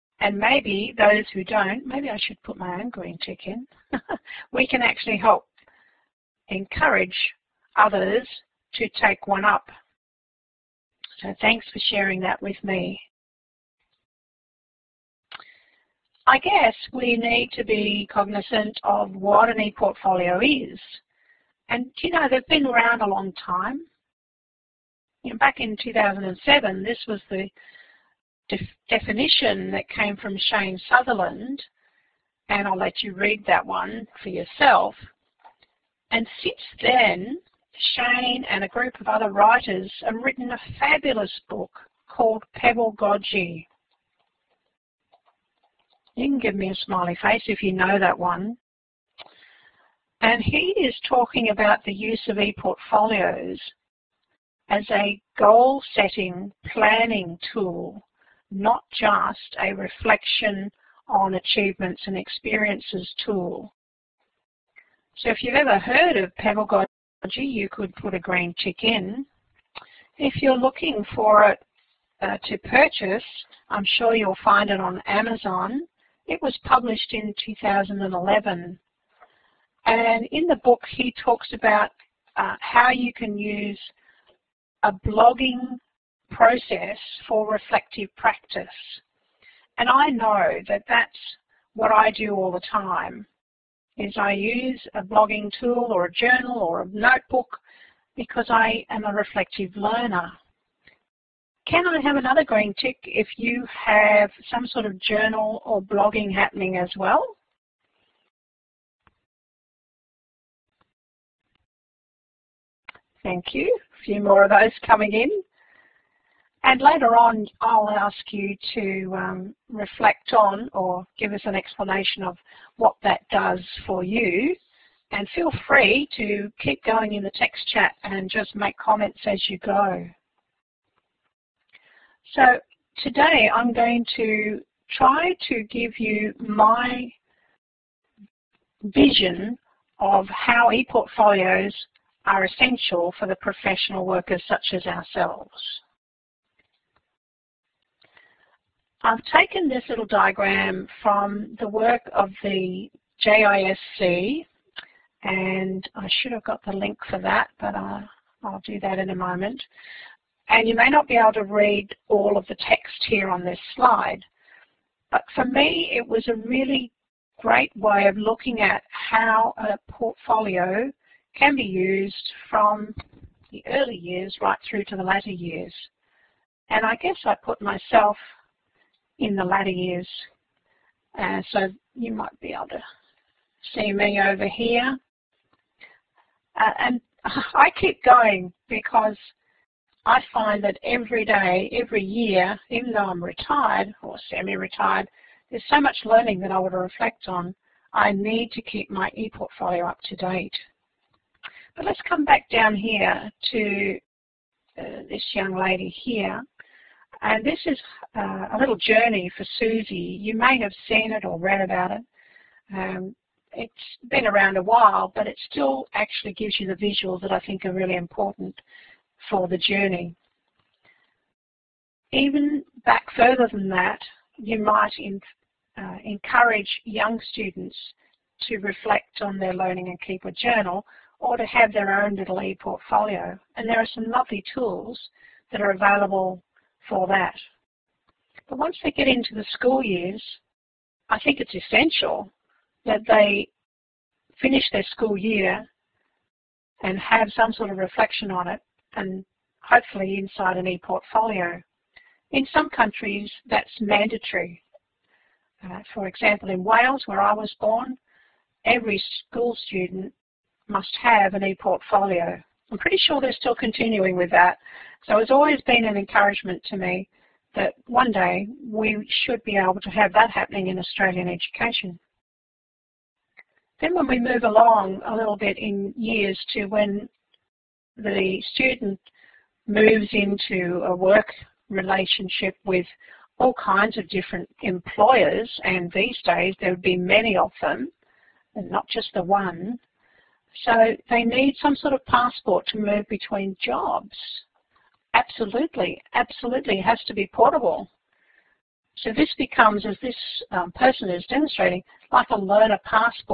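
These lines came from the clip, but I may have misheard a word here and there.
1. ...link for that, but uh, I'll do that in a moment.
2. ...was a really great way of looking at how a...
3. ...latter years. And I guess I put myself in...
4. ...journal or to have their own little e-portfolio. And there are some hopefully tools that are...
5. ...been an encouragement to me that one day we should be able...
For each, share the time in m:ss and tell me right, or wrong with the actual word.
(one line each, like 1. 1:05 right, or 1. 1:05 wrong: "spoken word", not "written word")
1. 2:36 right
2. 2:46 right
3. 2:55 right
4. 3:50 wrong: "lovely", not "hopefully"
5. 4:25 right.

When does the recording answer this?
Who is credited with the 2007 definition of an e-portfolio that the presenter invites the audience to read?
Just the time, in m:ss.
0:30.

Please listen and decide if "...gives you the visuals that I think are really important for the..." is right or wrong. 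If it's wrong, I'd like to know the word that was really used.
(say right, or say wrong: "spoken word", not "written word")
right.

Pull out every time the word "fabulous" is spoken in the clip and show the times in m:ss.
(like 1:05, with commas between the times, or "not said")
0:40.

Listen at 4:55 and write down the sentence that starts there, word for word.
Absolutely, absolutely, it has to be portable.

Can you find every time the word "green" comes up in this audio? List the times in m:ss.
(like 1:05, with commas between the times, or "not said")
0:02, 1:08, 1:42.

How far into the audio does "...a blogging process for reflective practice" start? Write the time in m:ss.
1:24.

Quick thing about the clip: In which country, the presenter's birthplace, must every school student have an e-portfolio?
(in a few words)
Wales.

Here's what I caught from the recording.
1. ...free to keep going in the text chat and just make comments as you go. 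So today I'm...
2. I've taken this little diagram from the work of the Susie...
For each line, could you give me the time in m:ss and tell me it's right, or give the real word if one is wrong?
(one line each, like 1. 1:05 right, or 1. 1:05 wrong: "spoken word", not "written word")
1. 2:05 right
2. 2:29 wrong: "JISC", not "Susie".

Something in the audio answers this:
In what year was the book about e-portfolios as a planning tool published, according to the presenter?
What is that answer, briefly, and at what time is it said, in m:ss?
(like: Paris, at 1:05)
2011, at 1:17.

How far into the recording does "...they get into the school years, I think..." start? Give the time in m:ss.
3:58.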